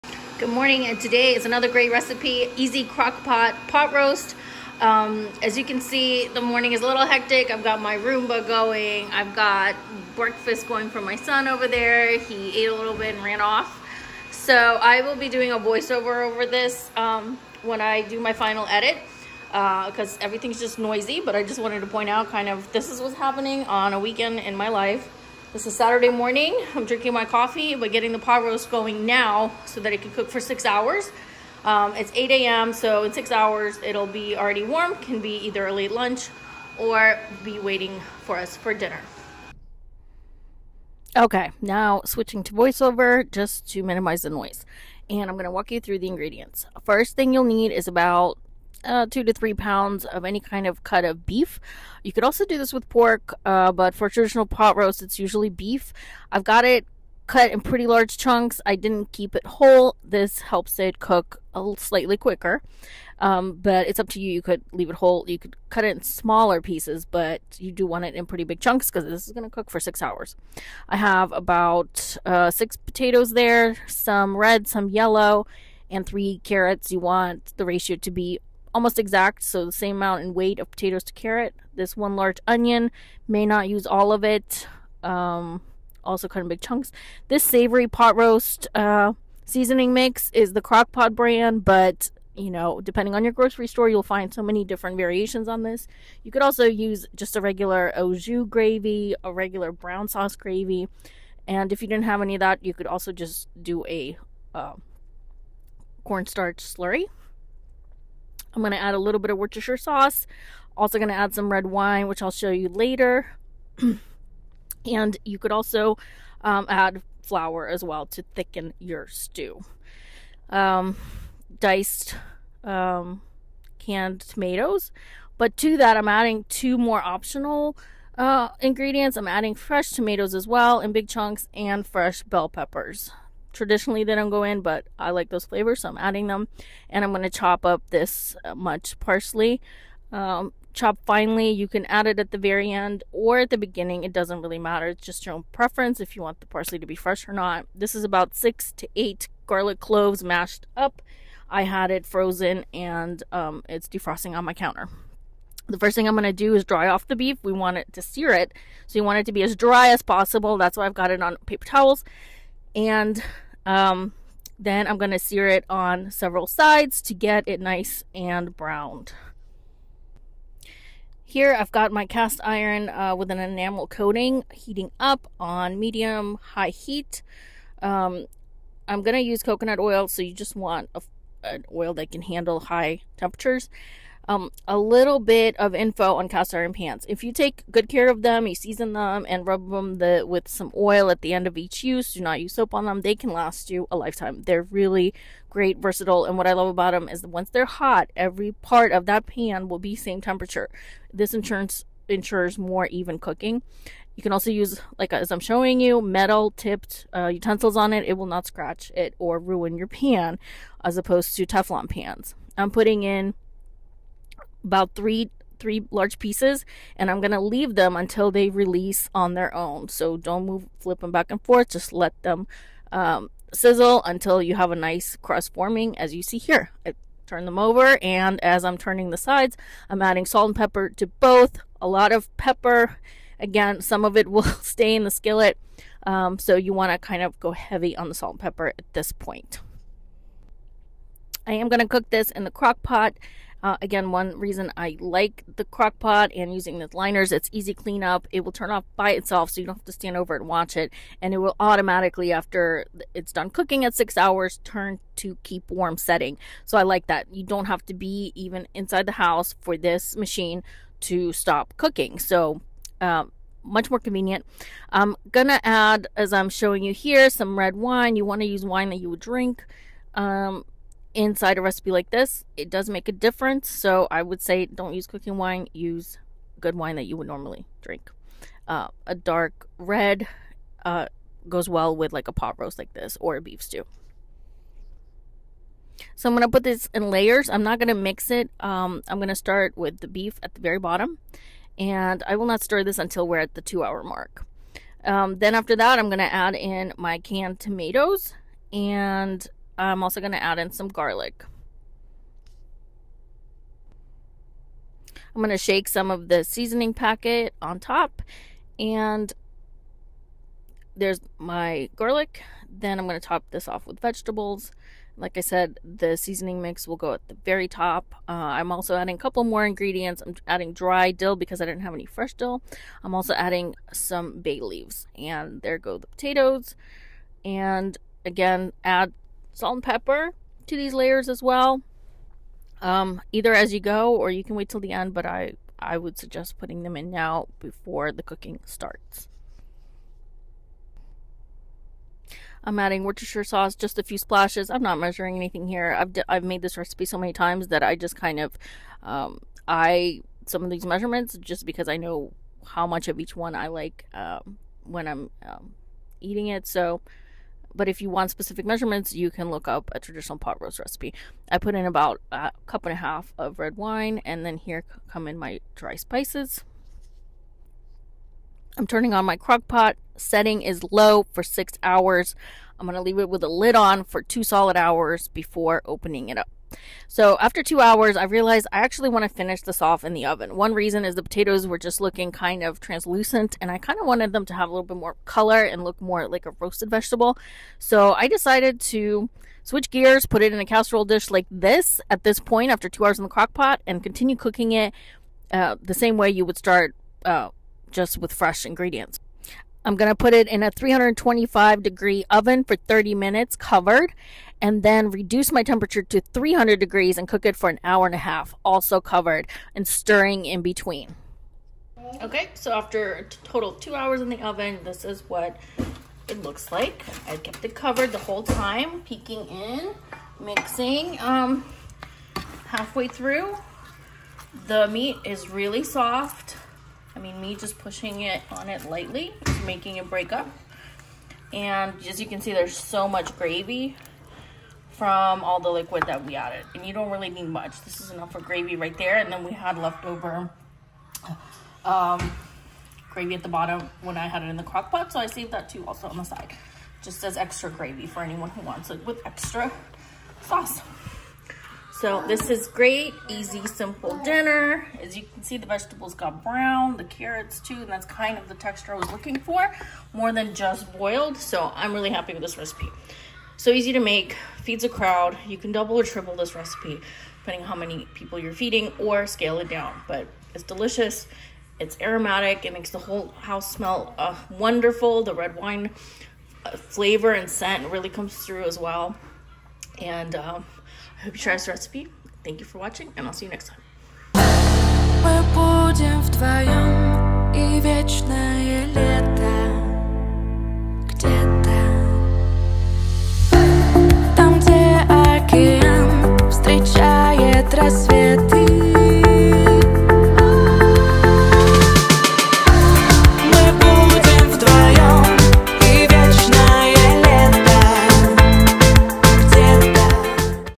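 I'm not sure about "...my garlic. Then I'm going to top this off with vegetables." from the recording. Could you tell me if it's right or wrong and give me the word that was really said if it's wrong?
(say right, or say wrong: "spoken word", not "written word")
right.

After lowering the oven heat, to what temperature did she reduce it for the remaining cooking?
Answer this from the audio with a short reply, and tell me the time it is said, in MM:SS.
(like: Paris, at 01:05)
300 degrees, at 06:46.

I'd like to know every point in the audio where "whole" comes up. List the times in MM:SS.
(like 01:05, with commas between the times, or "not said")
00:59, 01:04, 06:58, 07:52.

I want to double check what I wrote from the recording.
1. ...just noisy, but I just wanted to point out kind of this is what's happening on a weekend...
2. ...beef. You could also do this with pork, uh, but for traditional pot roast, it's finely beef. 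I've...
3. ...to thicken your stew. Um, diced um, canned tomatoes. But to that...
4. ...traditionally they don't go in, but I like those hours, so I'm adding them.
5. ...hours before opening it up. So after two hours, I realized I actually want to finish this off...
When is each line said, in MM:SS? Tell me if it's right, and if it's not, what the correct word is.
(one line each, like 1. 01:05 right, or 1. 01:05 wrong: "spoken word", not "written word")
1. 00:20 right
2. 00:51 wrong: "usually", not "finely"
3. 01:58 right
4. 02:13 wrong: "flavors", not "hours"
5. 06:14 right.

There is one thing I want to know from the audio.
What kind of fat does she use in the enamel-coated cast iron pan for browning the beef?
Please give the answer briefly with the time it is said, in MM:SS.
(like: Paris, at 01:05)
coconut oil, at 02:59.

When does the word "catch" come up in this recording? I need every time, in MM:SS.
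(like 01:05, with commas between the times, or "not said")
not said.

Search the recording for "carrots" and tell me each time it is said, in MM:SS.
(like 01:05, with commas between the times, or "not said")
01:16, 01:21, 07:37.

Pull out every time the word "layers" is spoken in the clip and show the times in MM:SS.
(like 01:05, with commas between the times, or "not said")
04:47, 05:30.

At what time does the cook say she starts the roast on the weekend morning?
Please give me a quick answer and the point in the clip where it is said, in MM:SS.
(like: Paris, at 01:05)
8 a.m., at 00:32.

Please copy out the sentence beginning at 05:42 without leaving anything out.
I'm adding Worcestershire sauce, just a few splashes.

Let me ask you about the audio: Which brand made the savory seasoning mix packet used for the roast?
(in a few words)
Crock-Pot.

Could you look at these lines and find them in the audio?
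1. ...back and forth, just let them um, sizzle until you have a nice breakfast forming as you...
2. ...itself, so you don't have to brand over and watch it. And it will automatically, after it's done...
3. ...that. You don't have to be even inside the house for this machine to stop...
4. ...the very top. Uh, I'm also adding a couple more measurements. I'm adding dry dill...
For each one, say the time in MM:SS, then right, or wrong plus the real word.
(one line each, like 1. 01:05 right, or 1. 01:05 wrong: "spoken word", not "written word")
1. 03:41 wrong: "crust", not "breakfast"
2. 04:09 wrong: "stand", not "brand"
3. 04:17 right
4. 05:17 wrong: "ingredients", not "measurements".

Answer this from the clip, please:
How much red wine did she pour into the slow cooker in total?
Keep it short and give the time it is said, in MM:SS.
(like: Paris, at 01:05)
1.5 cups, at 06:02.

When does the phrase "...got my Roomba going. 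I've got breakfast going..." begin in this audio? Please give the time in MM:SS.
00:07.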